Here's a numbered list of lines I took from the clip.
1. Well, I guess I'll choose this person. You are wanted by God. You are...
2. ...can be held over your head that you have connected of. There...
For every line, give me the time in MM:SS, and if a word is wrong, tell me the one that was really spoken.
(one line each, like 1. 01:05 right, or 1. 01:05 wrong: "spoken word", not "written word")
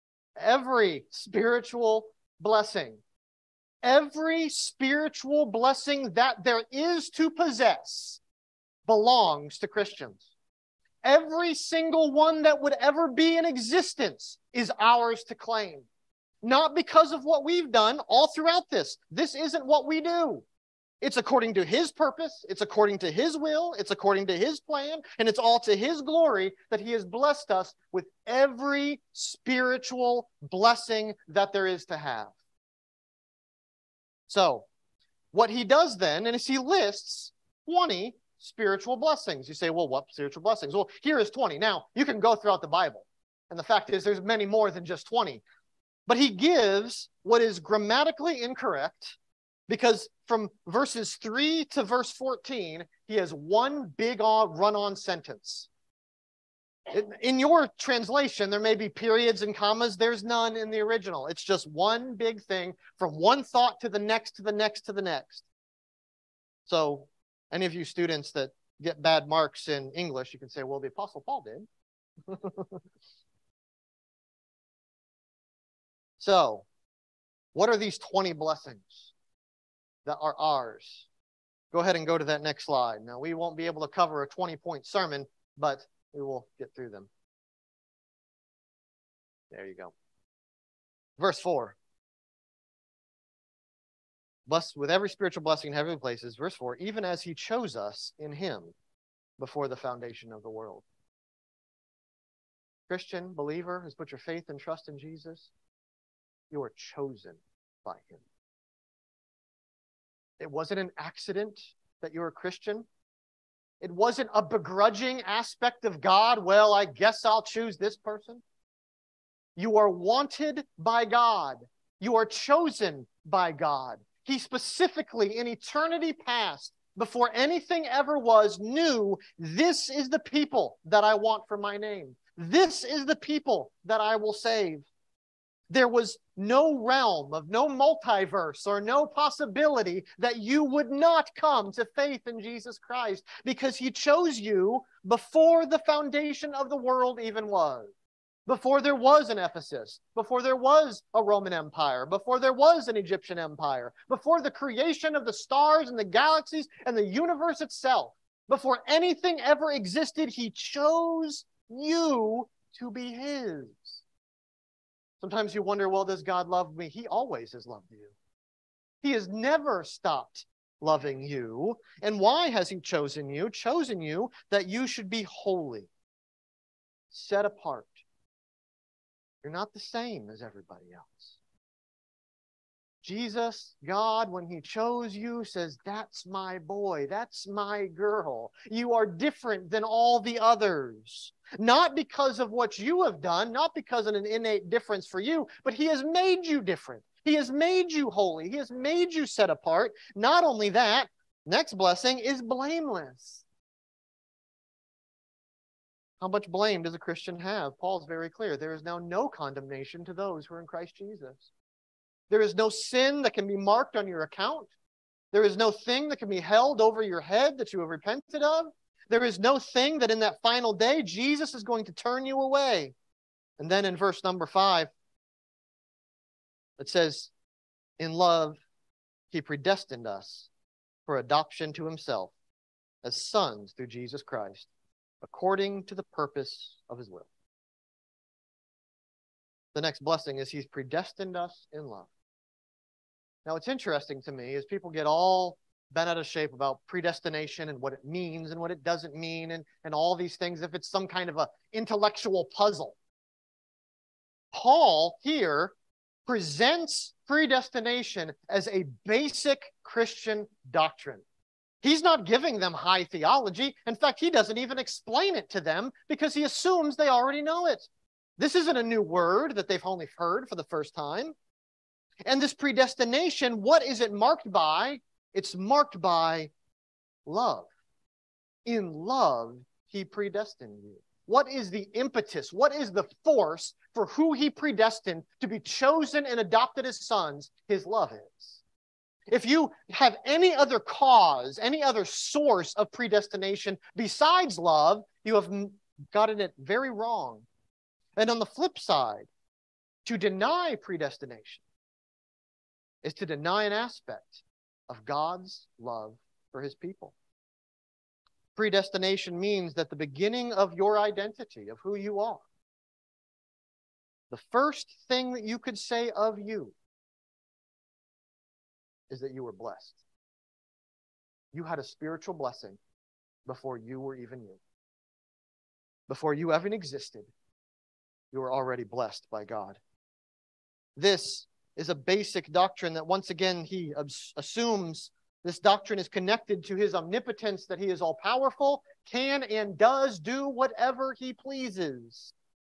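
1. 01:56 right
2. 03:36 wrong: "repented", not "connected".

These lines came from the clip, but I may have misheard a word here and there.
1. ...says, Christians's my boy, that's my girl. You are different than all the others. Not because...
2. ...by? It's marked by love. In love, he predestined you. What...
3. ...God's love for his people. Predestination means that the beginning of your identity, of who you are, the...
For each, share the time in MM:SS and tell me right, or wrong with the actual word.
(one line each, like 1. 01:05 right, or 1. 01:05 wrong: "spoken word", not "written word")
1. 03:05 wrong: "That", not "Christians"
2. 04:34 right
3. 05:05 right.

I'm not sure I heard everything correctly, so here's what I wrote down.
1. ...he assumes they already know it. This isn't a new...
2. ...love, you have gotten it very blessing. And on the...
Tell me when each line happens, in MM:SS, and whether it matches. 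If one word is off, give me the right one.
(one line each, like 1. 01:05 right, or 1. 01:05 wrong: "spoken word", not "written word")
1. 04:26 right
2. 04:54 wrong: "wrong", not "blessing".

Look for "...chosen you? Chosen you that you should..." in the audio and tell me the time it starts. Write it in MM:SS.
02:52.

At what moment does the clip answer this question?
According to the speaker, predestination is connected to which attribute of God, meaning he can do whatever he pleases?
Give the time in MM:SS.
05:36.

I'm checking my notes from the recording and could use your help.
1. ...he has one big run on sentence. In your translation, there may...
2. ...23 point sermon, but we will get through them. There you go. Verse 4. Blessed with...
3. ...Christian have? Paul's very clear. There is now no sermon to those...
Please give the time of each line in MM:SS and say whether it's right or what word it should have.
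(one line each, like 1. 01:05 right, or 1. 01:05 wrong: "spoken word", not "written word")
1. 00:53 right
2. 01:24 wrong: "20", not "23"
3. 03:26 wrong: "condemnation", not "sermon".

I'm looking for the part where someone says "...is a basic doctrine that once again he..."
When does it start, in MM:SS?
05:31.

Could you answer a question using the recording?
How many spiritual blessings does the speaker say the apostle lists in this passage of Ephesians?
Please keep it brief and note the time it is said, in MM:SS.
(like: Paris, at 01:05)
20, at 00:37.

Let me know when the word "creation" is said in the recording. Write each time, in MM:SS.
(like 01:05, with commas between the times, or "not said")
02:34.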